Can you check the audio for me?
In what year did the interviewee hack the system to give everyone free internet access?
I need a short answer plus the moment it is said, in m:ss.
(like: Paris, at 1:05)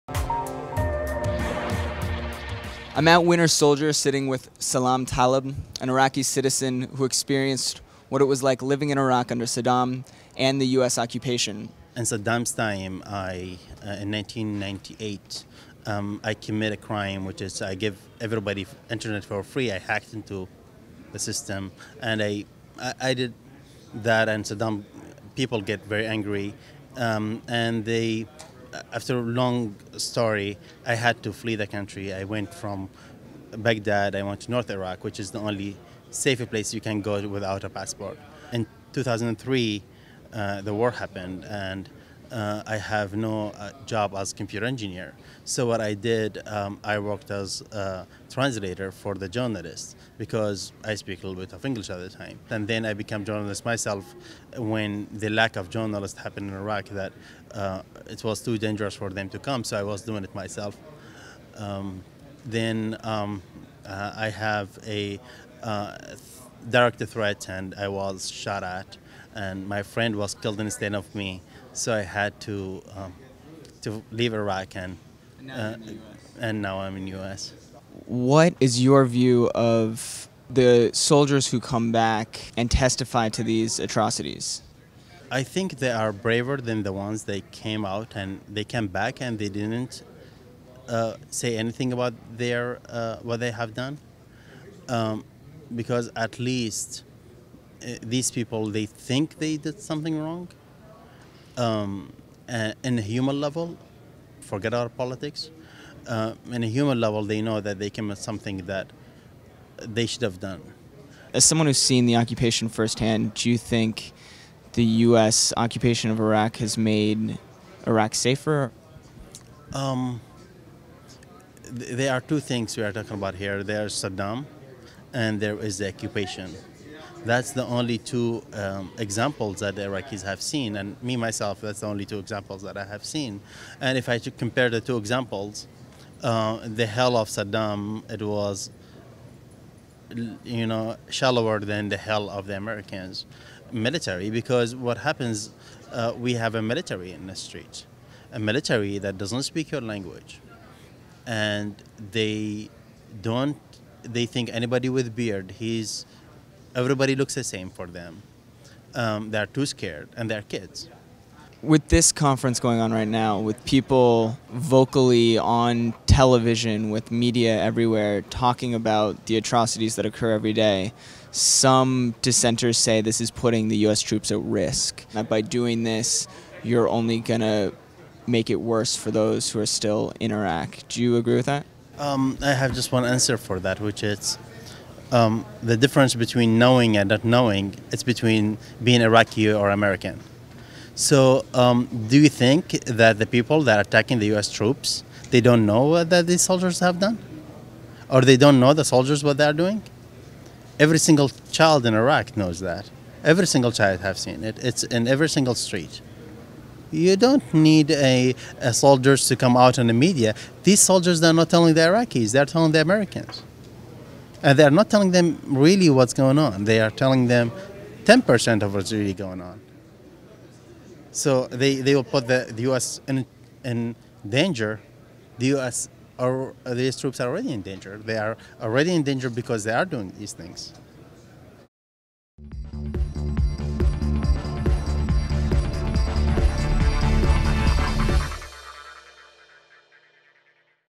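1998, at 0:14.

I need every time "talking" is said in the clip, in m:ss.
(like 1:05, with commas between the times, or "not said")
2:02, 2:48.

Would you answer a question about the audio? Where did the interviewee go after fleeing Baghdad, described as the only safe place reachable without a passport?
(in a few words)
North Iraq.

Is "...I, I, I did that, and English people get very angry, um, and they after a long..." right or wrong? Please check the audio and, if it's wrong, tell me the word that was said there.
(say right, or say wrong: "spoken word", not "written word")
wrong: "Saddam", not "English".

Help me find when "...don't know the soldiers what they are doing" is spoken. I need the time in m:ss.
3:18.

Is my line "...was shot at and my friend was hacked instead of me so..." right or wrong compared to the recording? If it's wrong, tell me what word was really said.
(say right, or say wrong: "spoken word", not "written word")
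wrong: "killed", not "hacked".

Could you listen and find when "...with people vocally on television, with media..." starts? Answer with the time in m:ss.
2:43.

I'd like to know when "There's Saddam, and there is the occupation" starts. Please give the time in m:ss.
2:03.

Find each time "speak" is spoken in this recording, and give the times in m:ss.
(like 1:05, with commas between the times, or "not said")
0:50, 2:29.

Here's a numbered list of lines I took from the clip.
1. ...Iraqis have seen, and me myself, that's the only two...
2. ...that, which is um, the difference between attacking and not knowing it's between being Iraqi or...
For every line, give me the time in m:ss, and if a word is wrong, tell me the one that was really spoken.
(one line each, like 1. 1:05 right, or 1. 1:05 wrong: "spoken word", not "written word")
1. 2:09 right
2. 3:03 wrong: "knowing", not "attacking".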